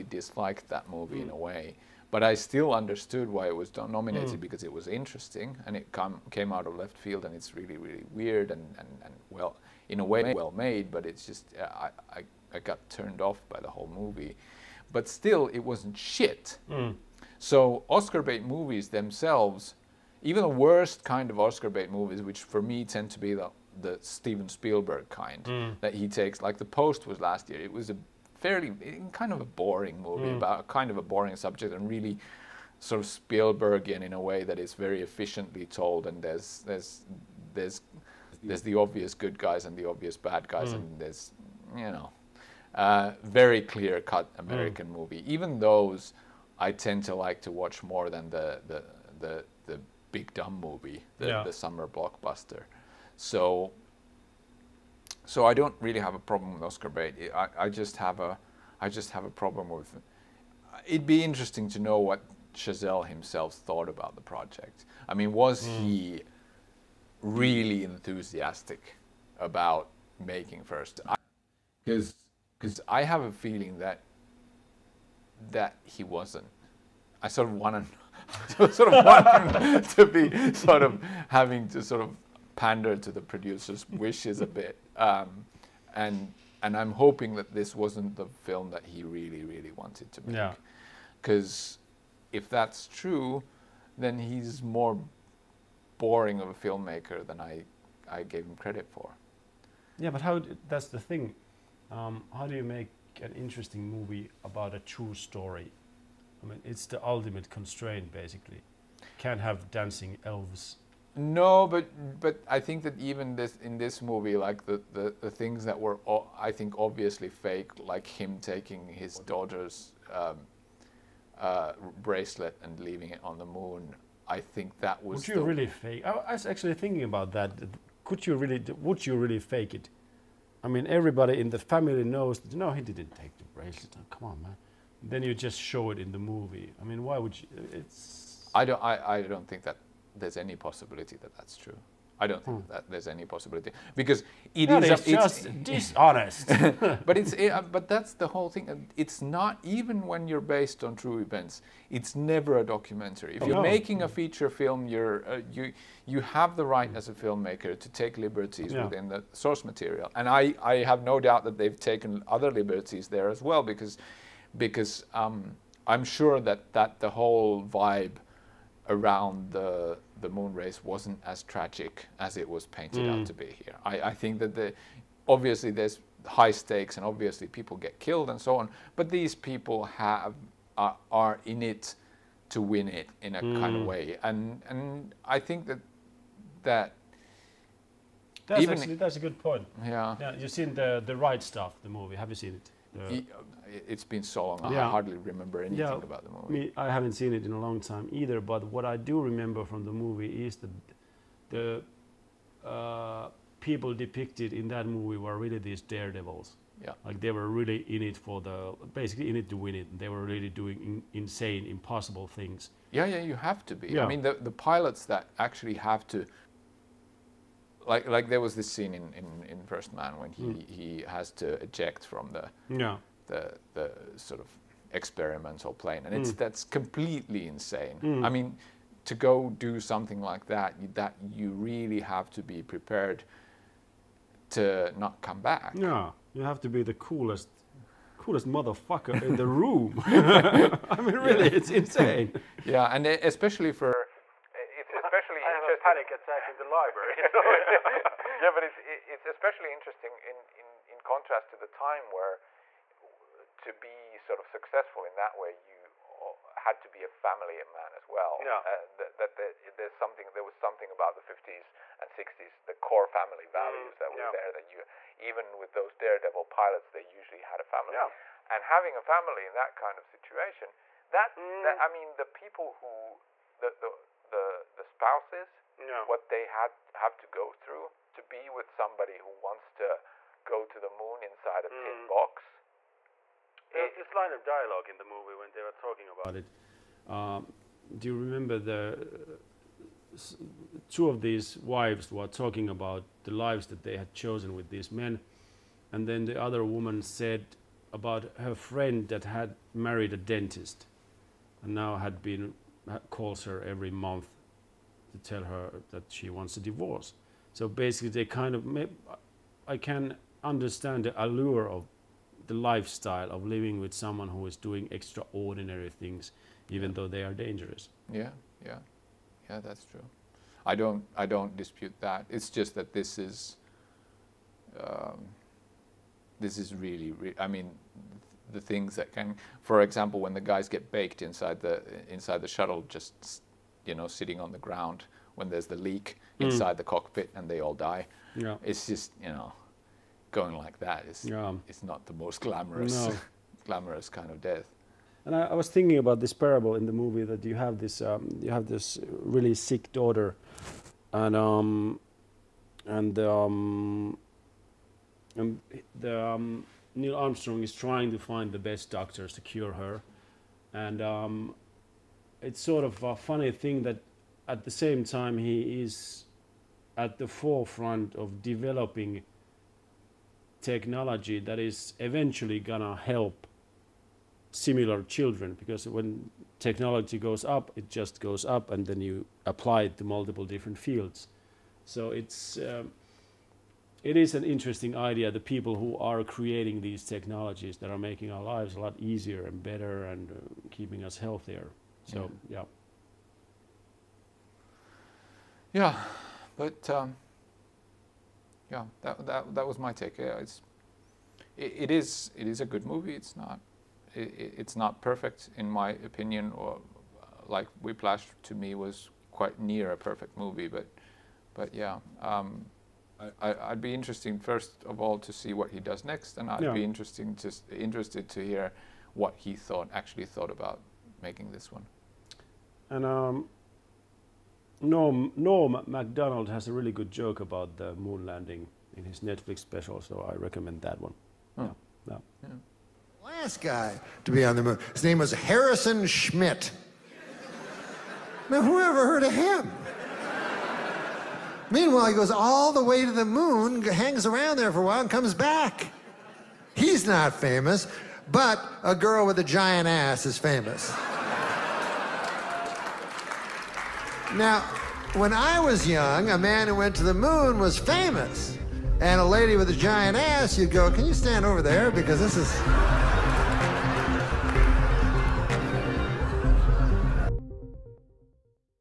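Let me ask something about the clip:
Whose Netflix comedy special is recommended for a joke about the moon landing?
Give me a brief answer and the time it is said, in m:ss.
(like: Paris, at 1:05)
Norm Macdonald, at 7:04.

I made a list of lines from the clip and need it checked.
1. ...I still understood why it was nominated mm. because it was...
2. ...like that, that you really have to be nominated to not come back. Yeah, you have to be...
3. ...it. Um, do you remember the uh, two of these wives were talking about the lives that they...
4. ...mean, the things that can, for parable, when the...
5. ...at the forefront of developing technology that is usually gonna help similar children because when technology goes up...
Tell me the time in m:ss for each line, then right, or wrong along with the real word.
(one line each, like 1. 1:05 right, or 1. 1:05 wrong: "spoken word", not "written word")
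1. 0:02 right
2. 3:50 wrong: "prepared", not "nominated"
3. 4:46 right
4. 5:27 wrong: "example", not "parable"
5. 6:06 wrong: "eventually", not "usually".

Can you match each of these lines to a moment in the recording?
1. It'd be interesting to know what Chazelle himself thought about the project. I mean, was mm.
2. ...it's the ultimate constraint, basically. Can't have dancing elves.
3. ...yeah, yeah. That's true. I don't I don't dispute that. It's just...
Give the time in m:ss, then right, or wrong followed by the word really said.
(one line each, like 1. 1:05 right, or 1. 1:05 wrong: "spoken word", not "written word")
1. 1:00 right
2. 1:46 right
3. 5:18 right.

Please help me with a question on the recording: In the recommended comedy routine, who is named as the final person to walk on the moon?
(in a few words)
Harrison Schmitt.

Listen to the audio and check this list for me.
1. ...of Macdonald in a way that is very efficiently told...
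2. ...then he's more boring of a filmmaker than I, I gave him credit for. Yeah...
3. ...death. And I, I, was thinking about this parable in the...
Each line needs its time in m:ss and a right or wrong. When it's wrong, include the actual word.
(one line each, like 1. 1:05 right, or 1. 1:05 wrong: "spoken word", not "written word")
1. 0:33 wrong: "Spielbergian", not "Macdonald"
2. 1:33 right
3. 5:44 right.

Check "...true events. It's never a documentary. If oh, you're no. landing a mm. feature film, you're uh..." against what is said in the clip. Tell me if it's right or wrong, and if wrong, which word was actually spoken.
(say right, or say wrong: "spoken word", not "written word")
wrong: "making", not "landing".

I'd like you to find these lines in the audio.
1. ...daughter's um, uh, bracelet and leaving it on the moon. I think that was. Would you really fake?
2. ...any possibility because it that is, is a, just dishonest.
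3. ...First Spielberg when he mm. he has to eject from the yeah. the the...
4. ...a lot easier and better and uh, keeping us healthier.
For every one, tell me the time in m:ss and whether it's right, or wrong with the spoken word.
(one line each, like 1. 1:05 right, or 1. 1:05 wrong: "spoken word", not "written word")
1. 1:59 right
2. 2:23 right
3. 3:39 wrong: "Man", not "Spielberg"
4. 6:28 right.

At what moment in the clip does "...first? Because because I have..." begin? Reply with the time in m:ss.
1:10.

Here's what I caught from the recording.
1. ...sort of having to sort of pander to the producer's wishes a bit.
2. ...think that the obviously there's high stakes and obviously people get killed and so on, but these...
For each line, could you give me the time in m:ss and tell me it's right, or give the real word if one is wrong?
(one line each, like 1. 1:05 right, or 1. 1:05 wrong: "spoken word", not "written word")
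1. 1:20 right
2. 2:54 right.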